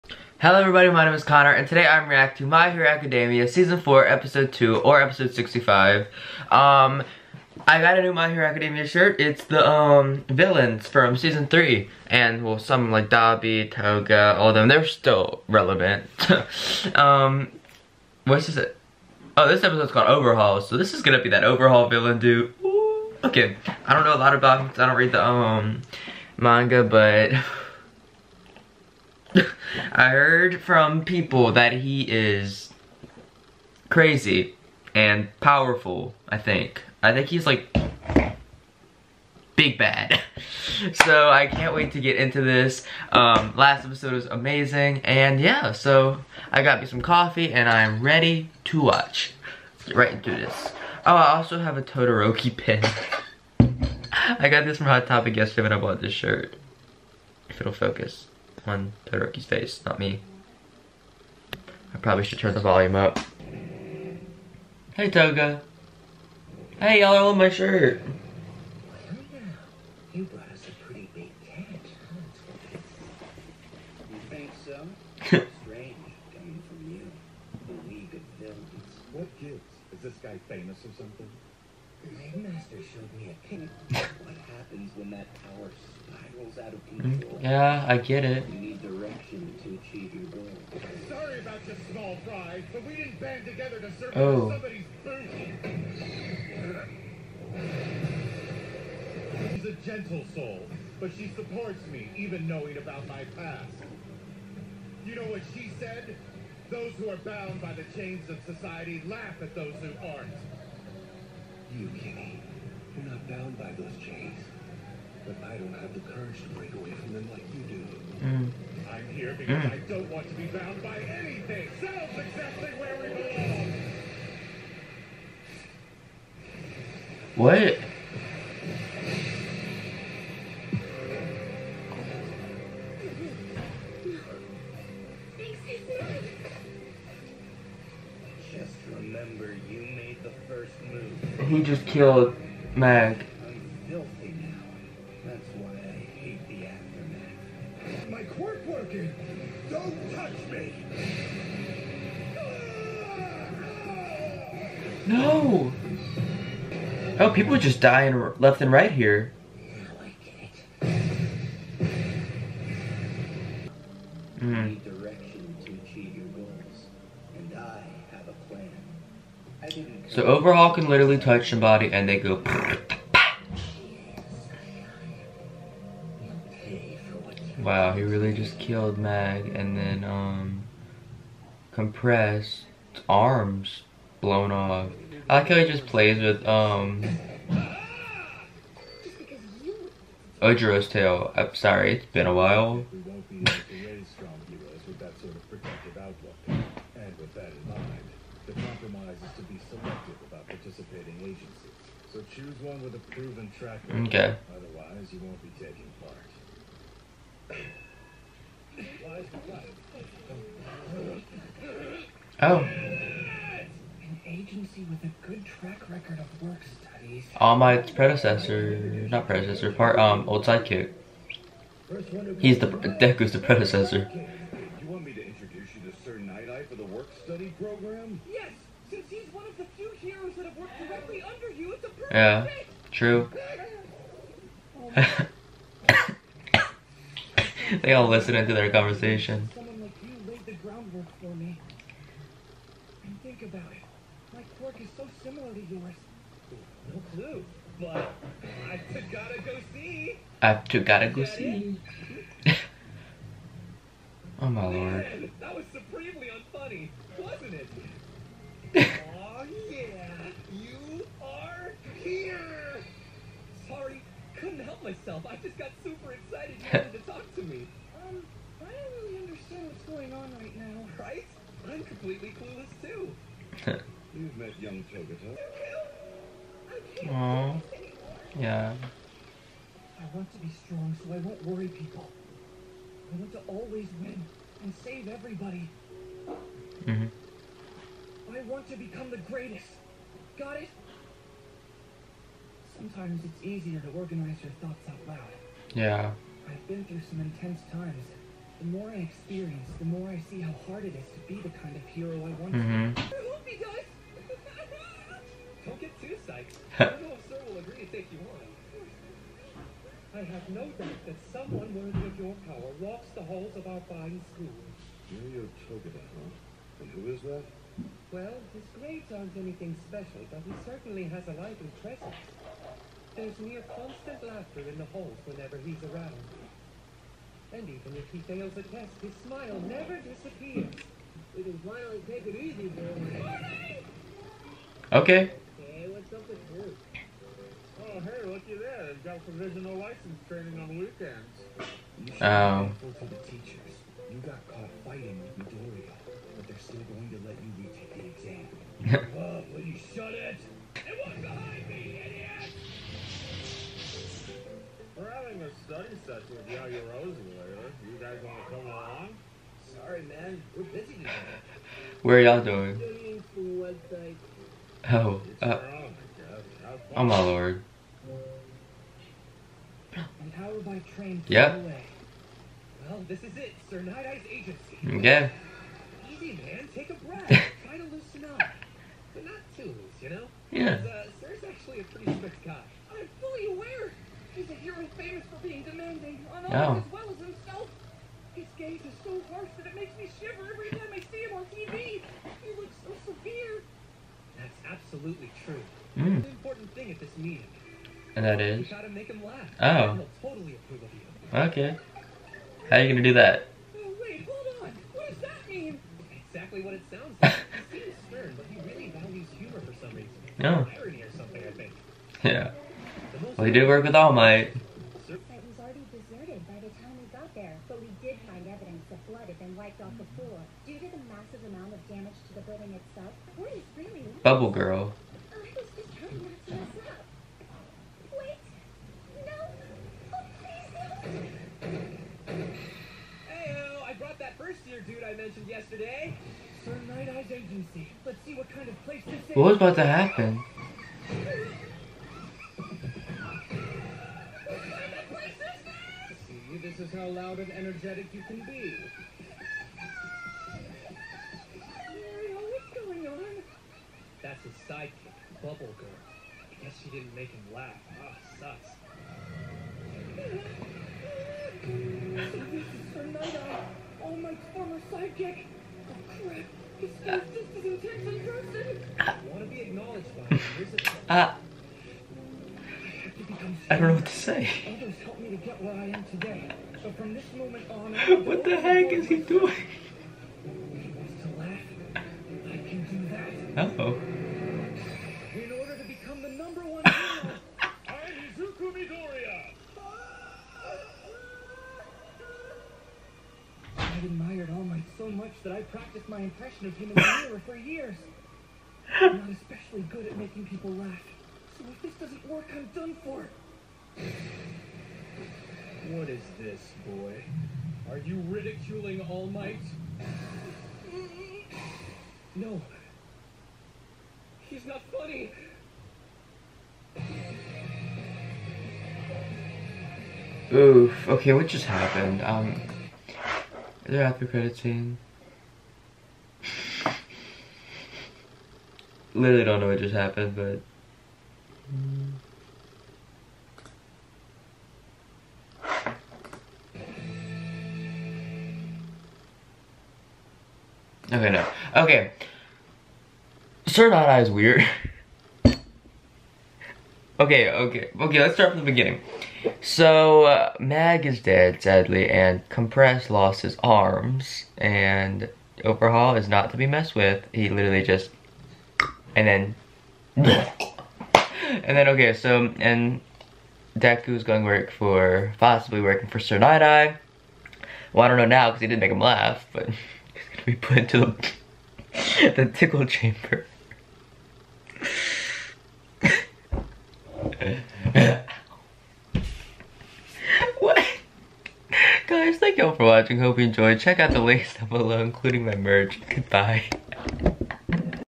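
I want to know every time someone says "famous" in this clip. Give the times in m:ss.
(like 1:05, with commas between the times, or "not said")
1:20, 6:24.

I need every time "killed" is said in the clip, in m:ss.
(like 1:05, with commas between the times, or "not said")
2:21, 2:58.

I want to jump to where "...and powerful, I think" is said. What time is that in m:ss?
0:34.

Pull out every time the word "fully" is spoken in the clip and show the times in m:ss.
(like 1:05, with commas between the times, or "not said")
6:23.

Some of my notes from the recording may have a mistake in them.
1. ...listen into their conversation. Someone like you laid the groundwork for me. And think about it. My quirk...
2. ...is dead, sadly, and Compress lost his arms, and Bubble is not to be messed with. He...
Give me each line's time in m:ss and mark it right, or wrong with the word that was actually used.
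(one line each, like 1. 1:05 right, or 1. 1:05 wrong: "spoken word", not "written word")
1. 3:58 right
2. 9:11 wrong: "Overhaul", not "Bubble".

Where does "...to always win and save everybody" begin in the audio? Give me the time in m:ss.
4:43.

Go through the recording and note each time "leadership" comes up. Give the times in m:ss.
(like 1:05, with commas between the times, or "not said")
not said.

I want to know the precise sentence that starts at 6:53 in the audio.
Well, he did work with All Might.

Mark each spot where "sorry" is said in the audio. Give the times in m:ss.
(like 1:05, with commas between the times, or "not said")
1:31, 3:11, 5:59.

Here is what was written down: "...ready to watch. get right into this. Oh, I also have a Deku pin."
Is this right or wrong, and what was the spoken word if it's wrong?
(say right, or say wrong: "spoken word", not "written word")
wrong: "Todoroki", not "Deku".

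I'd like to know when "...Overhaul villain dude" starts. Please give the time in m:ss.
0:21.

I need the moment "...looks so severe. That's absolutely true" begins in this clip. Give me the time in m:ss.
6:32.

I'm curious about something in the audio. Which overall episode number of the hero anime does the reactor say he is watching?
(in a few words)
Episode 65.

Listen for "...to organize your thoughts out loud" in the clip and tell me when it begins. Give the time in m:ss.
4:53.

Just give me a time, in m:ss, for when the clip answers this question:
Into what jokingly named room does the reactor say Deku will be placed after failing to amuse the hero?
9:32.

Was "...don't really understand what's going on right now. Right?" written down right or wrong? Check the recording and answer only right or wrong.
right.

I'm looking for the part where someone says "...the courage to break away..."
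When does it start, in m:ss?
1:55.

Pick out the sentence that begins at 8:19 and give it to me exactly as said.
I'm not especially good at making people laugh.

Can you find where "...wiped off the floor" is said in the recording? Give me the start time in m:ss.
6:59.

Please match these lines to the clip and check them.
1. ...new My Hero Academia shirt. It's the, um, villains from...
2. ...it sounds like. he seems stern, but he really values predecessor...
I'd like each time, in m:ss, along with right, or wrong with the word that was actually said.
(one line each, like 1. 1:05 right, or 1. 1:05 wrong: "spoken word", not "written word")
1. 0:08 right
2. 6:46 wrong: "humor", not "predecessor".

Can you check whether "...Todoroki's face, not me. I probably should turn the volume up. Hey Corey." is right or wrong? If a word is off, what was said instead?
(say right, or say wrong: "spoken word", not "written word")
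wrong: "Toga", not "Corey".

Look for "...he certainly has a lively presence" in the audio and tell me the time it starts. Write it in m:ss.
5:20.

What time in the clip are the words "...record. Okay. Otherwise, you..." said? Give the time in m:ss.
3:23.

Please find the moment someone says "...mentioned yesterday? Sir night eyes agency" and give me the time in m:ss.
7:15.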